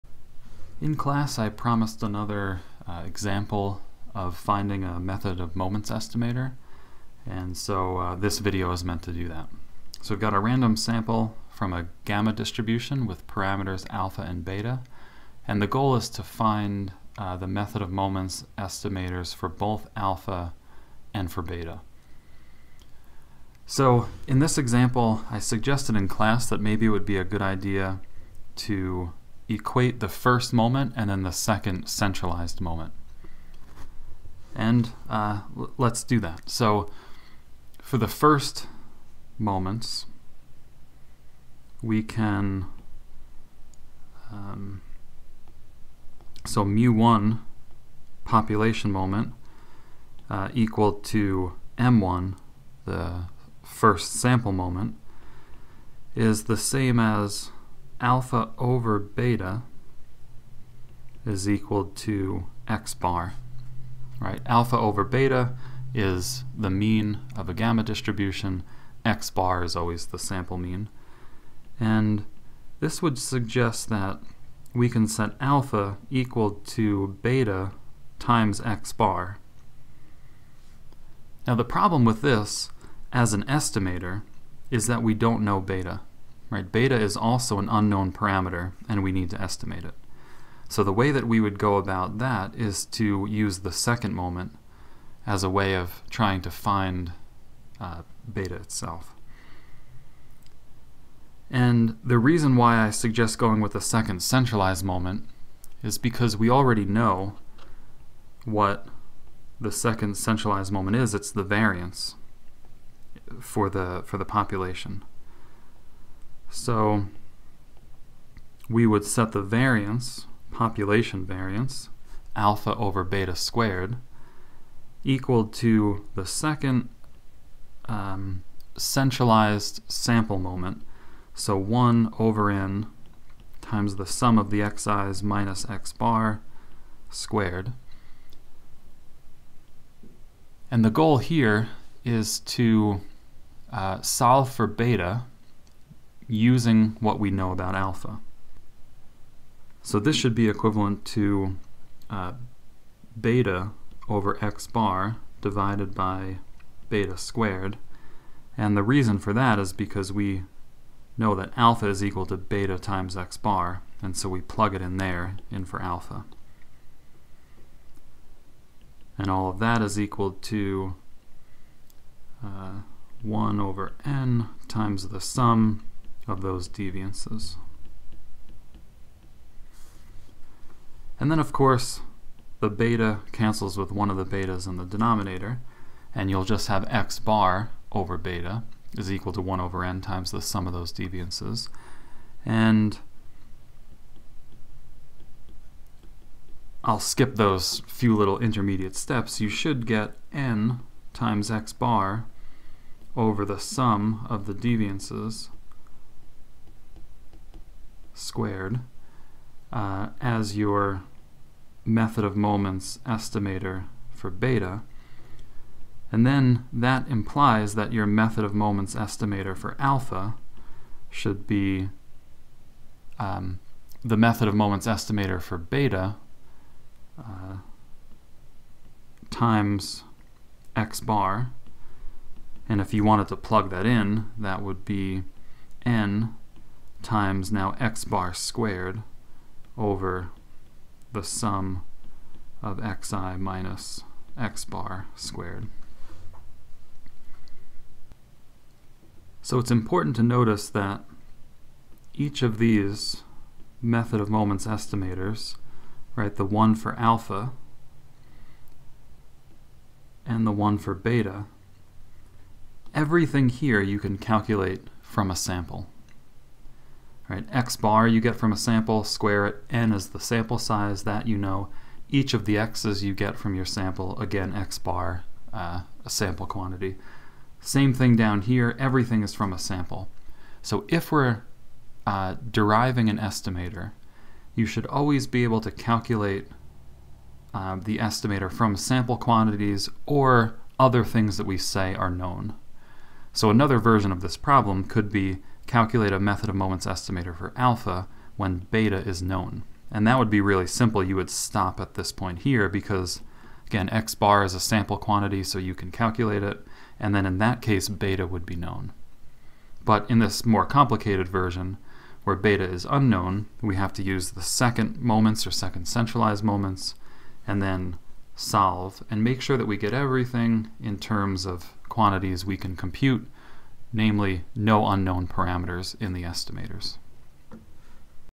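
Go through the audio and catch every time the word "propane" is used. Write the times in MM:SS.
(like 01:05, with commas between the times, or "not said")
not said.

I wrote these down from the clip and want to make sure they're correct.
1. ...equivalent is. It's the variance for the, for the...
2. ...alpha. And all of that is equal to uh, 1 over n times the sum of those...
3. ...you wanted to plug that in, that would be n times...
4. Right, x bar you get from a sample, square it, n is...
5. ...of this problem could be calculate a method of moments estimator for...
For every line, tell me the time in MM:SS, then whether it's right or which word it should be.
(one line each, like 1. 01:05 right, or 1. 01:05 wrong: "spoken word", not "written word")
1. 01:50 wrong: "moment", not "equivalent"
2. 02:45 right
3. 03:52 right
4. 04:27 right
5. 04:54 right.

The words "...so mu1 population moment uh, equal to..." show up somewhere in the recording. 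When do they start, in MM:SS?
00:46.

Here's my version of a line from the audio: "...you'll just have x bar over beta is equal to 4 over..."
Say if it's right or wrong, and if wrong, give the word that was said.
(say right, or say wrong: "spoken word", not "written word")
wrong: "1", not "4".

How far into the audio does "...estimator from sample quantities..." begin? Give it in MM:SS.
04:47.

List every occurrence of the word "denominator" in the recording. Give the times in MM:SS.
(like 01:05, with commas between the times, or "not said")
03:04.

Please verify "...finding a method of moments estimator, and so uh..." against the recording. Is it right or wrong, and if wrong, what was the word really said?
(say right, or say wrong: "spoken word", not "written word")
right.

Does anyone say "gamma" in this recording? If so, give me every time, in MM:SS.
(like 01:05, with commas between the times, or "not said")
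00:12, 01:07.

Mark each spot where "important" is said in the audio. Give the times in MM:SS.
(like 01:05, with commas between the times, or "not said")
04:09.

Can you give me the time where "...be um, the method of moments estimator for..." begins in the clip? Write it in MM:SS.
03:41.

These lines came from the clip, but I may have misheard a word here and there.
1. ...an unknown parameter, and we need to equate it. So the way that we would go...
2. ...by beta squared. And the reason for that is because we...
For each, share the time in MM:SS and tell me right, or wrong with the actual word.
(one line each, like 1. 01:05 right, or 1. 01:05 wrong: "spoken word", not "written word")
1. 01:27 wrong: "estimate", not "equate"
2. 02:35 right.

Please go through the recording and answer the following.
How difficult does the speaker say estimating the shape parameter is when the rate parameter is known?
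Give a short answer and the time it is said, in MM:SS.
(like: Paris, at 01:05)
Really simple, at 05:00.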